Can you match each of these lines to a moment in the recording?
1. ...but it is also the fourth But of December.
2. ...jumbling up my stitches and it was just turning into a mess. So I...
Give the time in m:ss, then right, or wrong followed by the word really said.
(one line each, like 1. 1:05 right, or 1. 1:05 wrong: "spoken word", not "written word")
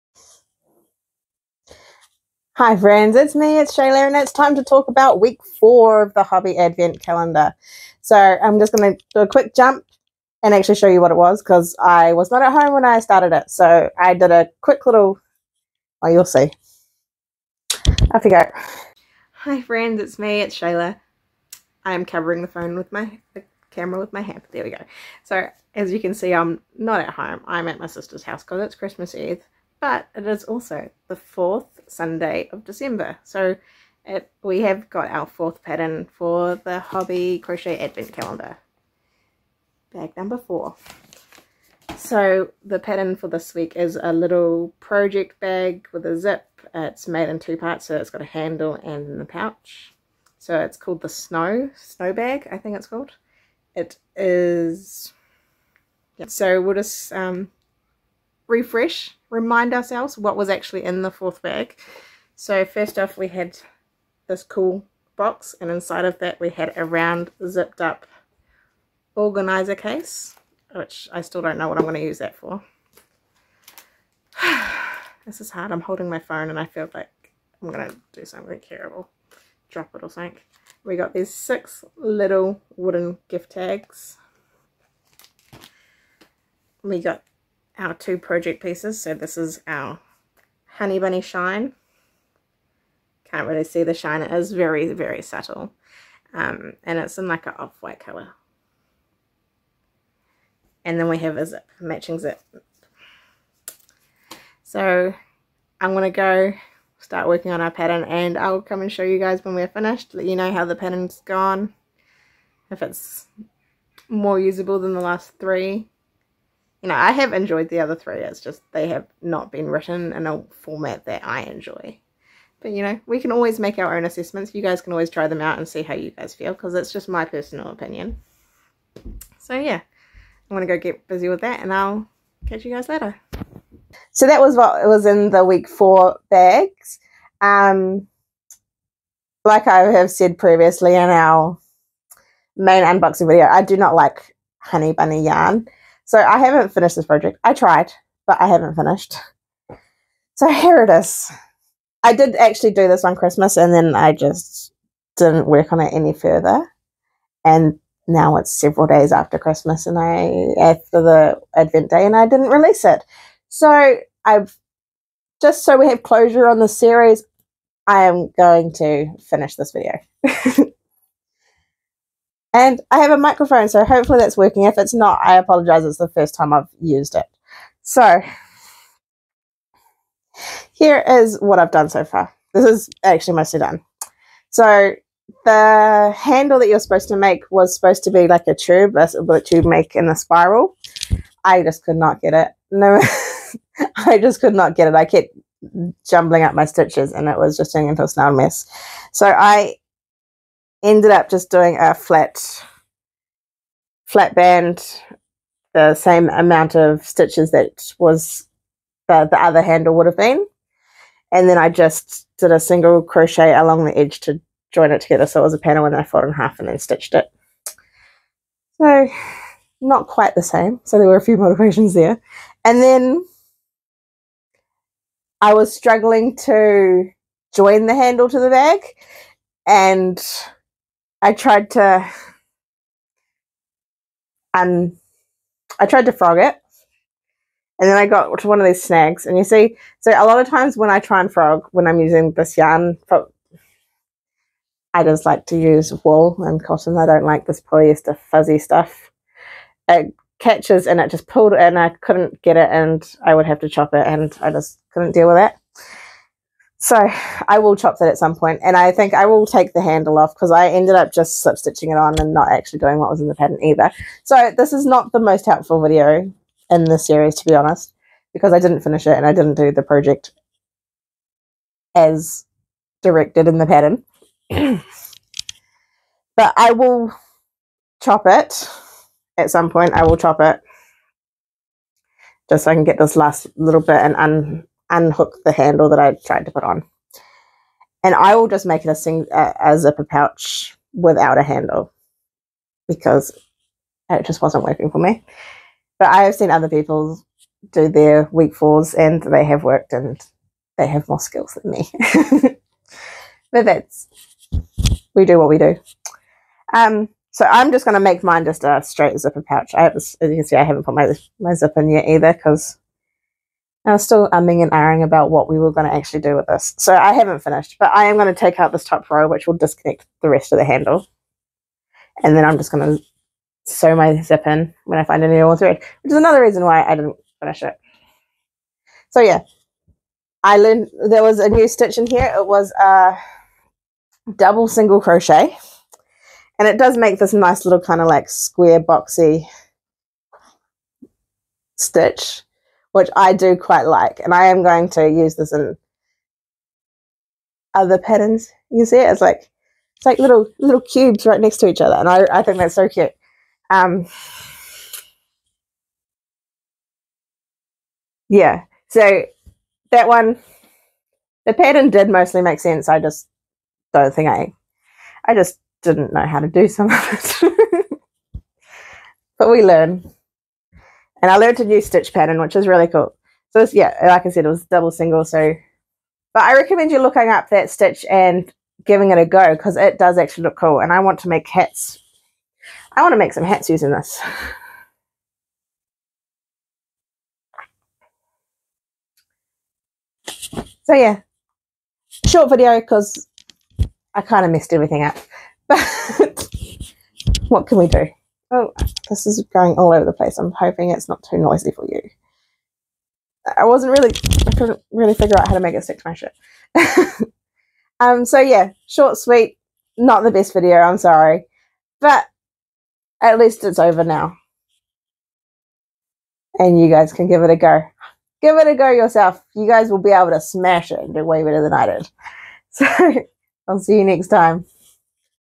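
1. 0:29 wrong: "Sunday", not "But"
2. 3:16 right.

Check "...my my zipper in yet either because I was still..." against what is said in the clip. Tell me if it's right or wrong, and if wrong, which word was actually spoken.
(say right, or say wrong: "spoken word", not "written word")
right.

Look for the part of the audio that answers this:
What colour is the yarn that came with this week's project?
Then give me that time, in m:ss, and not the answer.
1:37.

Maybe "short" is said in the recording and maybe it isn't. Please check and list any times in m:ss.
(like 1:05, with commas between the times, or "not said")
6:32, 6:48.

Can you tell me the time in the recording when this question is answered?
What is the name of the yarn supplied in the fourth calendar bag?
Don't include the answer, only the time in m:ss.
1:30.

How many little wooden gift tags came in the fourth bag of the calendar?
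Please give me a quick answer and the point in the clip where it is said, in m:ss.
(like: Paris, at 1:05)
6, at 1:21.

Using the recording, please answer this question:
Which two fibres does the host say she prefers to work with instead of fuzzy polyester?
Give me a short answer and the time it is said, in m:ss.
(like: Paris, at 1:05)
Wool and cotton, at 4:06.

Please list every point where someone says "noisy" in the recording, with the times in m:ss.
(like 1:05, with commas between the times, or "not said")
6:41.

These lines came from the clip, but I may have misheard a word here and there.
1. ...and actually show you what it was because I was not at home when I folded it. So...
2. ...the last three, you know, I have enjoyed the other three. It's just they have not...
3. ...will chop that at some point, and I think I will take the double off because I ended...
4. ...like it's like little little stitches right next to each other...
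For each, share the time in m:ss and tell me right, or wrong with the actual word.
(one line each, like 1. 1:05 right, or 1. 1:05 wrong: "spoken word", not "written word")
1. 0:10 wrong: "started", not "folded"
2. 1:54 right
3. 4:17 wrong: "handle", not "double"
4. 5:49 wrong: "cubes", not "stitches".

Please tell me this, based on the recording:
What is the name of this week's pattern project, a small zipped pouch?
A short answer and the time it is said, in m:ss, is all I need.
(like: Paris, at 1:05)
Snow Bag, at 0:51.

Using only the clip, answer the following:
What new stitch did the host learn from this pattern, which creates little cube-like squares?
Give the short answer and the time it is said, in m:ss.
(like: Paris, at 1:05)
Double single crochet, at 5:34.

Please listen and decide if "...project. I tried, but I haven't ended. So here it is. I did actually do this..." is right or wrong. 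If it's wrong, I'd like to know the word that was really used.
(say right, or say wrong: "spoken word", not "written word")
wrong: "finished", not "ended".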